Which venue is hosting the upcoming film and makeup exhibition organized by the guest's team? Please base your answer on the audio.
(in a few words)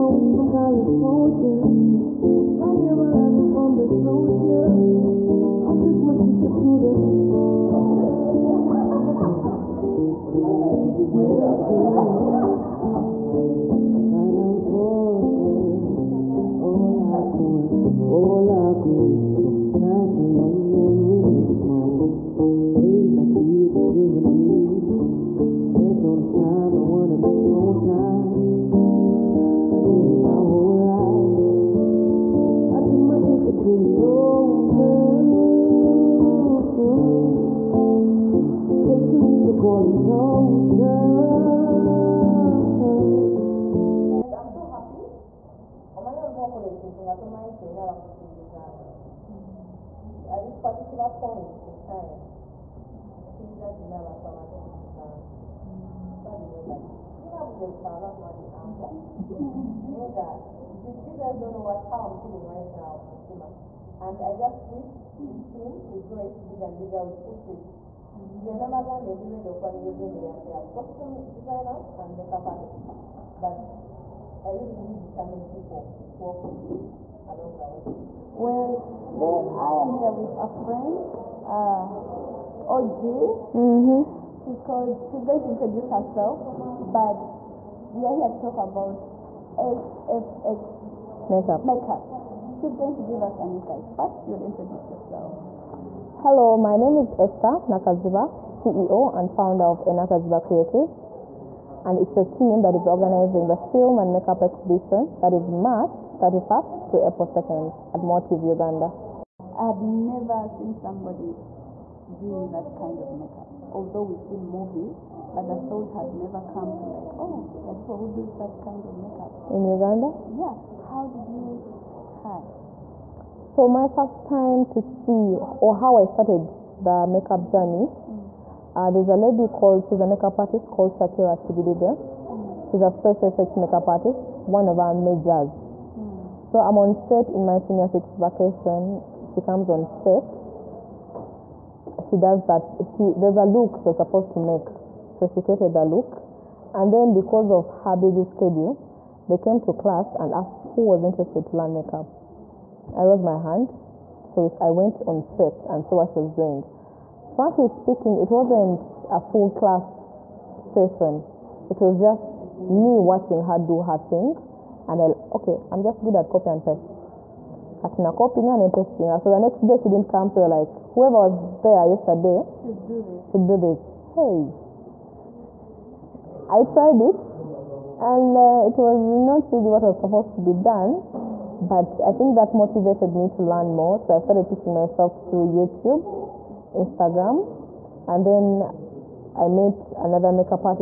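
Motive Uganda.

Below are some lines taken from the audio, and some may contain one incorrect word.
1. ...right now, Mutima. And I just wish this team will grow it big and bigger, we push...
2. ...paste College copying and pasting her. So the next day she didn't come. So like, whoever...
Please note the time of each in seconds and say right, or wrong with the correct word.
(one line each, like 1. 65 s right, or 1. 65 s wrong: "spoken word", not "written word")
1. 62 s right
2. 166 s wrong: "Katina", not "College".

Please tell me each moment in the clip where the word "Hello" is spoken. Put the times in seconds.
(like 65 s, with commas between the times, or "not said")
96 s.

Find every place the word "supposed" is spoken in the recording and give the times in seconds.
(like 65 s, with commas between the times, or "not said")
143 s, 179 s.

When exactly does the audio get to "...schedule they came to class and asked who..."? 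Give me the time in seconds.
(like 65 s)
148 s.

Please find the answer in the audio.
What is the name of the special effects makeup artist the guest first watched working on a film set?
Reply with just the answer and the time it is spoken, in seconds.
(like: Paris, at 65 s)
Shakira Chibidige, at 130 s.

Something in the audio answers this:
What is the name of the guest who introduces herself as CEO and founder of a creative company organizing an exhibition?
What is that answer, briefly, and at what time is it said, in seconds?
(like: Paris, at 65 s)
Esther Nakaziba, at 97 s.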